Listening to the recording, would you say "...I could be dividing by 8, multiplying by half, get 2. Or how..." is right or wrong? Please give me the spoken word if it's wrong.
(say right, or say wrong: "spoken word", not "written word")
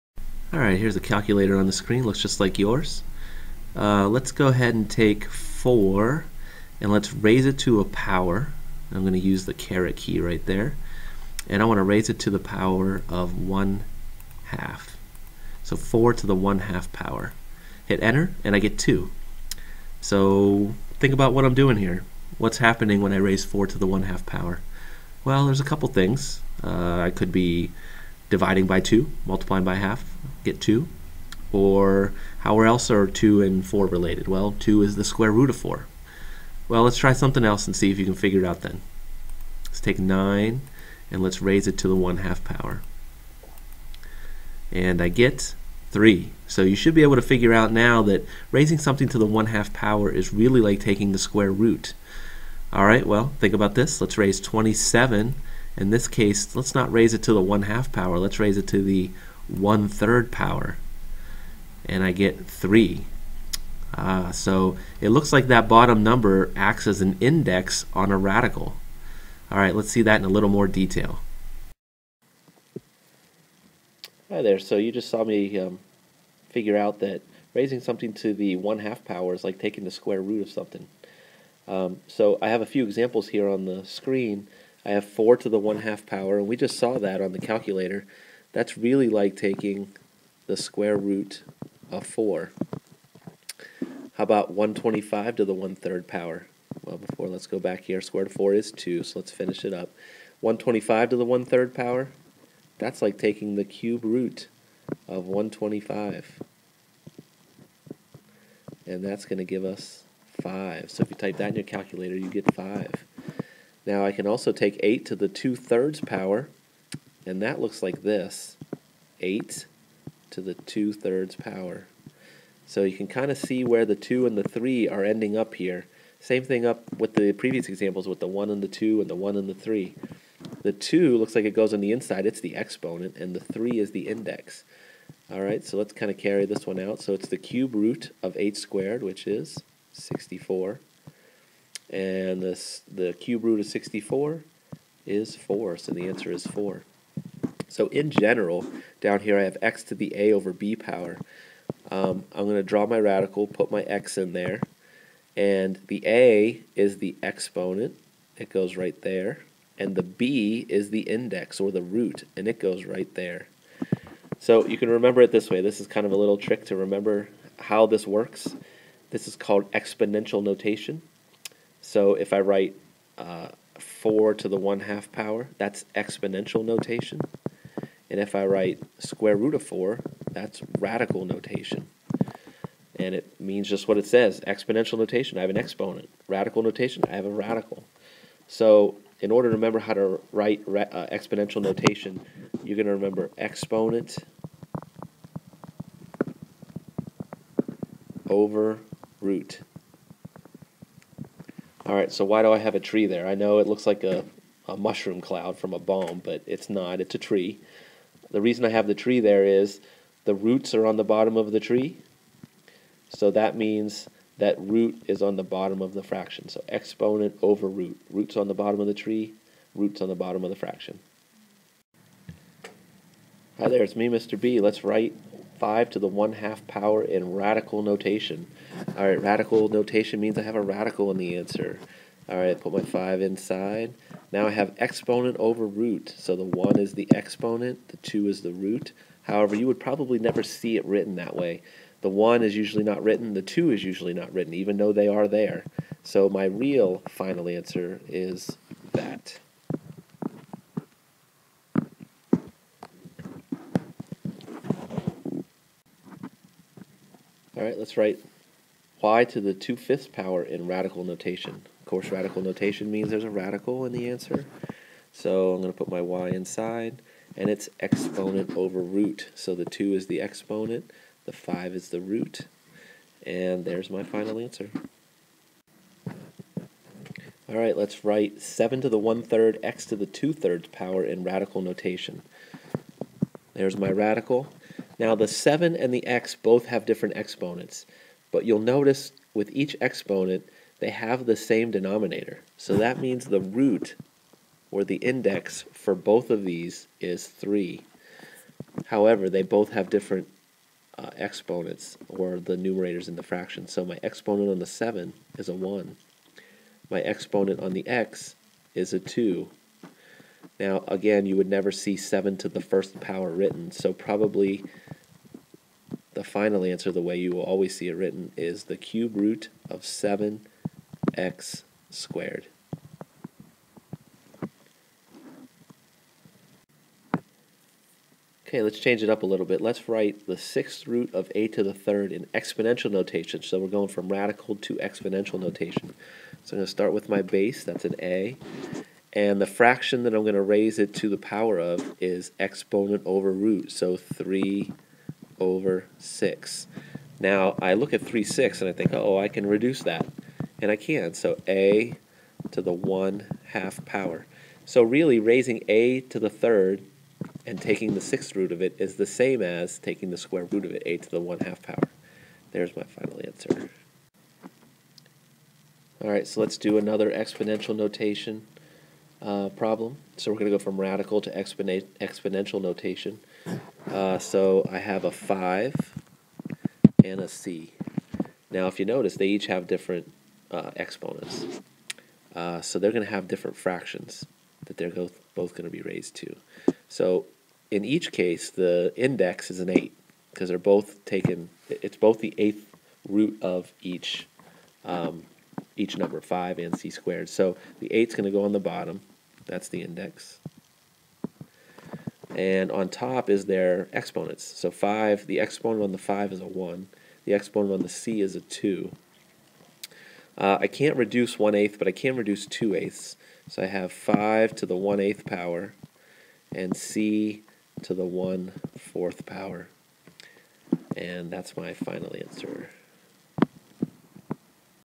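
wrong: "2", not "8".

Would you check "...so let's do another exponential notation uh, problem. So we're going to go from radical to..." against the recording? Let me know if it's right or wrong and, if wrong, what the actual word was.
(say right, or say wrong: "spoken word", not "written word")
right.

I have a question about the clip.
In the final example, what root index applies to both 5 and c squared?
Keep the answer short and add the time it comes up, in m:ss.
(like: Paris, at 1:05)
8, at 6:28.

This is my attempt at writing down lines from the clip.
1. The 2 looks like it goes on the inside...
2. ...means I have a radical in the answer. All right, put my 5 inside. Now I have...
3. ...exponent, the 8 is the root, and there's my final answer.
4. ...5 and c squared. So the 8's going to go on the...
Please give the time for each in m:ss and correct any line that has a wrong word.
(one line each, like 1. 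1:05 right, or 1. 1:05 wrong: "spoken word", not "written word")
1. 2:10 right
2. 3:50 right
3. 4:30 wrong: "5", not "8"
4. 6:36 right.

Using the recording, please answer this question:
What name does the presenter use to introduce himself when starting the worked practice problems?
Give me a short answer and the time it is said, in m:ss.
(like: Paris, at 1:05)
Mr. B, at 3:44.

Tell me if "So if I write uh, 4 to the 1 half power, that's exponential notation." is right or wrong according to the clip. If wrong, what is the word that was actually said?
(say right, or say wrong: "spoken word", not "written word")
right.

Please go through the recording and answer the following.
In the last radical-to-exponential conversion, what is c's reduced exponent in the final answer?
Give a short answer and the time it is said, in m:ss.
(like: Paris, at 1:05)
1/4, at 6:58.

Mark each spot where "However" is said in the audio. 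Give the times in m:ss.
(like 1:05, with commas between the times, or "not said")
3:59, 4:58.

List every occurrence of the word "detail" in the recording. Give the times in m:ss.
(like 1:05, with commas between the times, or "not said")
1:10.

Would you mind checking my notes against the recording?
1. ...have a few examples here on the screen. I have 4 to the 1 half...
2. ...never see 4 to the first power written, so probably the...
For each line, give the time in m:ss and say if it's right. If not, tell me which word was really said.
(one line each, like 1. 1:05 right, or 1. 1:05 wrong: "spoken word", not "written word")
1. 1:22 right
2. 5:11 wrong: "7", not "4".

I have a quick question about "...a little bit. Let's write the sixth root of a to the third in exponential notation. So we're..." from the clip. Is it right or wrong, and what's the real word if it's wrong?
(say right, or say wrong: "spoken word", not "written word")
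right.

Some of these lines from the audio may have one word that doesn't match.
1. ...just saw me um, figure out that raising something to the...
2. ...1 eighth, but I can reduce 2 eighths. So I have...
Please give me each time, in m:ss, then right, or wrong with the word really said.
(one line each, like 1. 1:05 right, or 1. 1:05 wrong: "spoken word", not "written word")
1. 1:14 right
2. 6:51 right.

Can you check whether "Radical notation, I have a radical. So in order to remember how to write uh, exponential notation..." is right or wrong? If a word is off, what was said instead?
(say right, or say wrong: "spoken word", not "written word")
right.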